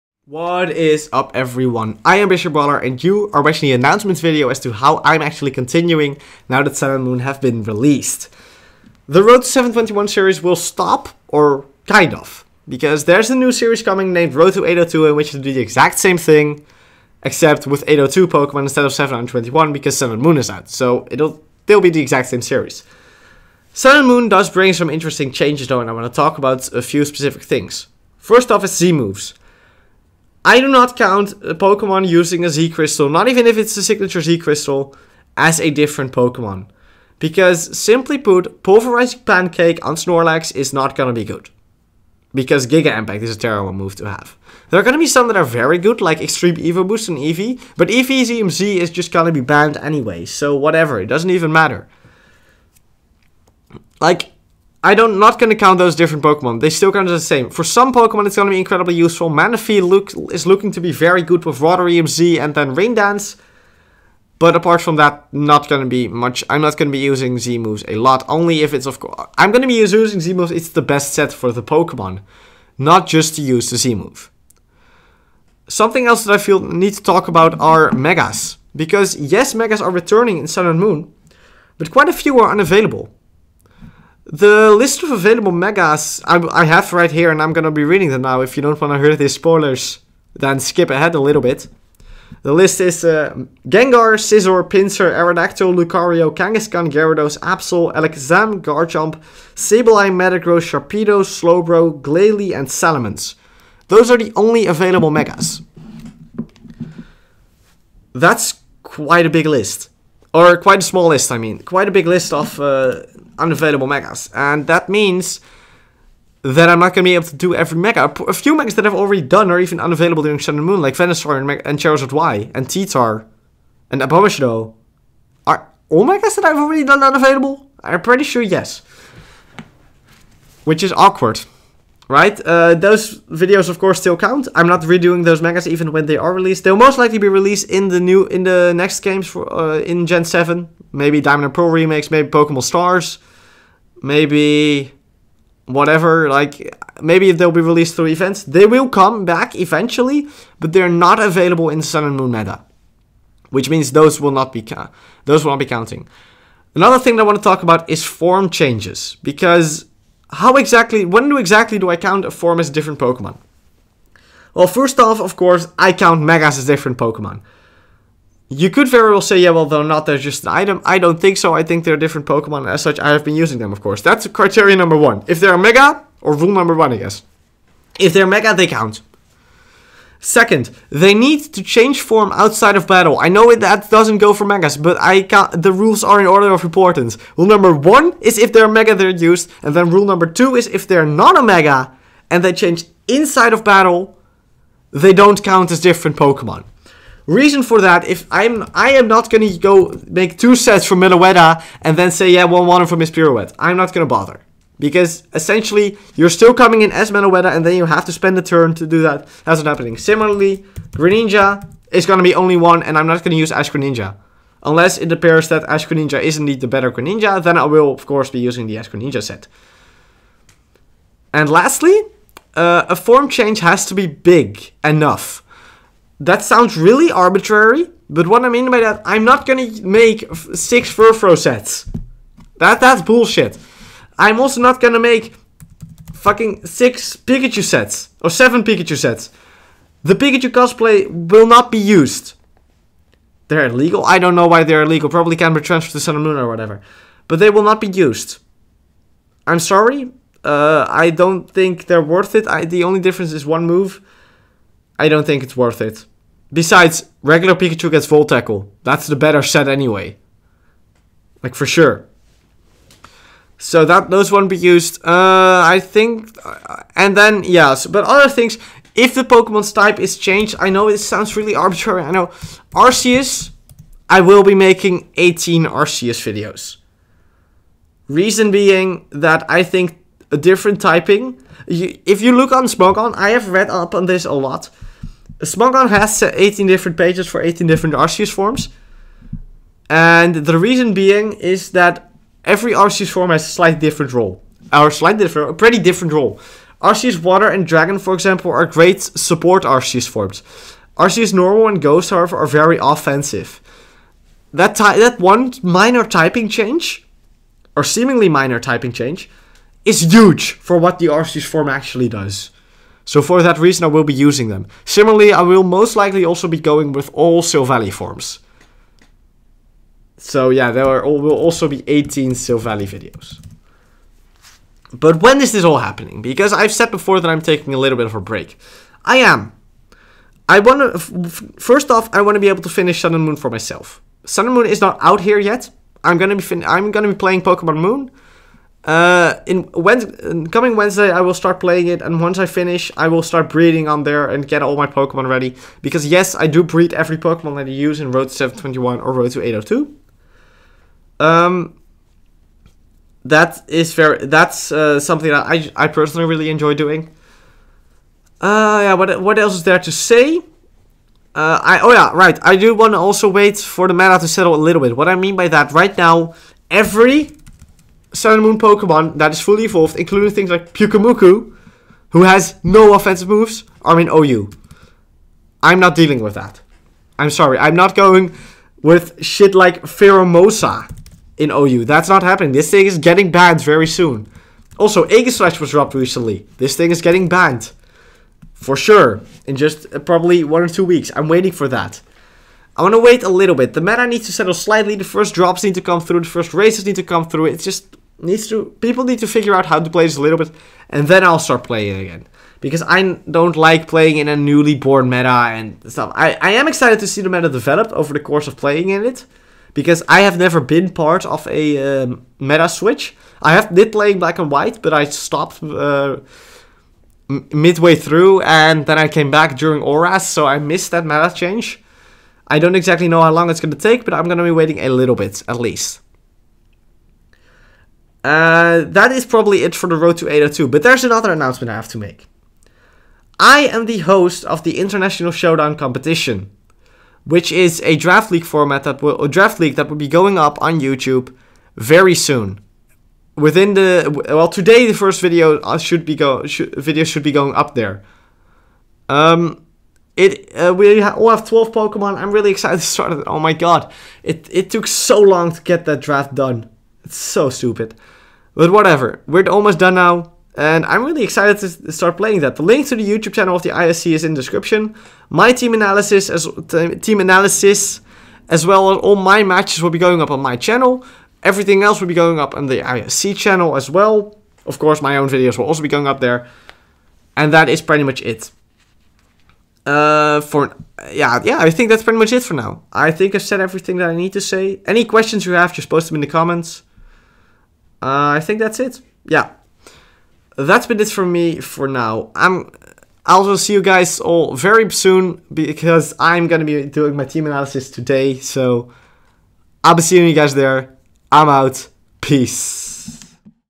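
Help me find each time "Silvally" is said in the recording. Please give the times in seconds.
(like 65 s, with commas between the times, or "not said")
317 s, 322 s.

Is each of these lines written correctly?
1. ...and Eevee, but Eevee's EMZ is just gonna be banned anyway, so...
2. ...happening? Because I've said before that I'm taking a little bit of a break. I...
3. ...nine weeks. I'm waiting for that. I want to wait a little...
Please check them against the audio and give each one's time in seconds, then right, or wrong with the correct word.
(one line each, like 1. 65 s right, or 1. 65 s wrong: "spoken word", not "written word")
1. 47 s right
2. 325 s right
3. 390 s wrong: "two", not "nine".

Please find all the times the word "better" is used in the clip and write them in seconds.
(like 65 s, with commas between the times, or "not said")
216 s, 259 s.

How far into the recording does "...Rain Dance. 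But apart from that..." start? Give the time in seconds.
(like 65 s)
62 s.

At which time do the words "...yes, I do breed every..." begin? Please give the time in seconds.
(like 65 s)
346 s.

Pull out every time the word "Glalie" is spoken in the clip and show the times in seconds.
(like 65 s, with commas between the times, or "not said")
102 s.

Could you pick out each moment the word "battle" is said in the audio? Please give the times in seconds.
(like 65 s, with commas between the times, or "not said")
182 s, 193 s.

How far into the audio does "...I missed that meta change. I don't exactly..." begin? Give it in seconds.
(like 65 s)
420 s.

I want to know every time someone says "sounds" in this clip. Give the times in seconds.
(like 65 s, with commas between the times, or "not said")
226 s, 270 s.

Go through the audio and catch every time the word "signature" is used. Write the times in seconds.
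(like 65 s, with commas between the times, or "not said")
33 s.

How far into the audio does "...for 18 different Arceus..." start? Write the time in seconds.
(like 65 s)
287 s.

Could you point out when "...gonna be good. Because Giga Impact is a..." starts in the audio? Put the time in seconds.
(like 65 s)
40 s.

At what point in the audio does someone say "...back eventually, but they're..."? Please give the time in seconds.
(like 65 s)
149 s.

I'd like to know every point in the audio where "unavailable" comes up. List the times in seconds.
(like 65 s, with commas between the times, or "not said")
82 s, 113 s, 119 s, 127 s.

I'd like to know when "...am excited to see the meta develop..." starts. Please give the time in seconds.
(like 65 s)
406 s.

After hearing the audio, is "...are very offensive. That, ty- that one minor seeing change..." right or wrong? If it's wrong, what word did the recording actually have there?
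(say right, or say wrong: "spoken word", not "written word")
wrong: "typing", not "seeing".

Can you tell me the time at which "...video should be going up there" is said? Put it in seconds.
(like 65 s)
446 s.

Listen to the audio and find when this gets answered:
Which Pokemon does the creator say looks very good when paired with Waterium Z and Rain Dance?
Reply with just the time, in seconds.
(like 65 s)
59 s.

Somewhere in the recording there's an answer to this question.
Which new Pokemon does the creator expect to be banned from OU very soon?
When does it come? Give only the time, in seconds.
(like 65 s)
379 s.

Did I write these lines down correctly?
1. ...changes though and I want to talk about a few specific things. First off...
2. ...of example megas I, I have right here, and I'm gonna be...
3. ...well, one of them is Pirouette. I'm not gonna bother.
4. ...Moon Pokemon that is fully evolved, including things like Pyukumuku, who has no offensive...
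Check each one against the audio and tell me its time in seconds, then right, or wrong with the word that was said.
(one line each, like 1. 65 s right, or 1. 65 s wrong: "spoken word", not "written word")
1. 25 s right
2. 85 s wrong: "available", not "example"
3. 202 s right
4. 368 s right.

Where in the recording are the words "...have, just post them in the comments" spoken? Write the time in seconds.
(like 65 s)
485 s.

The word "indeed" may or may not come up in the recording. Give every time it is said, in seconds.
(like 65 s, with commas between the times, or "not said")
216 s.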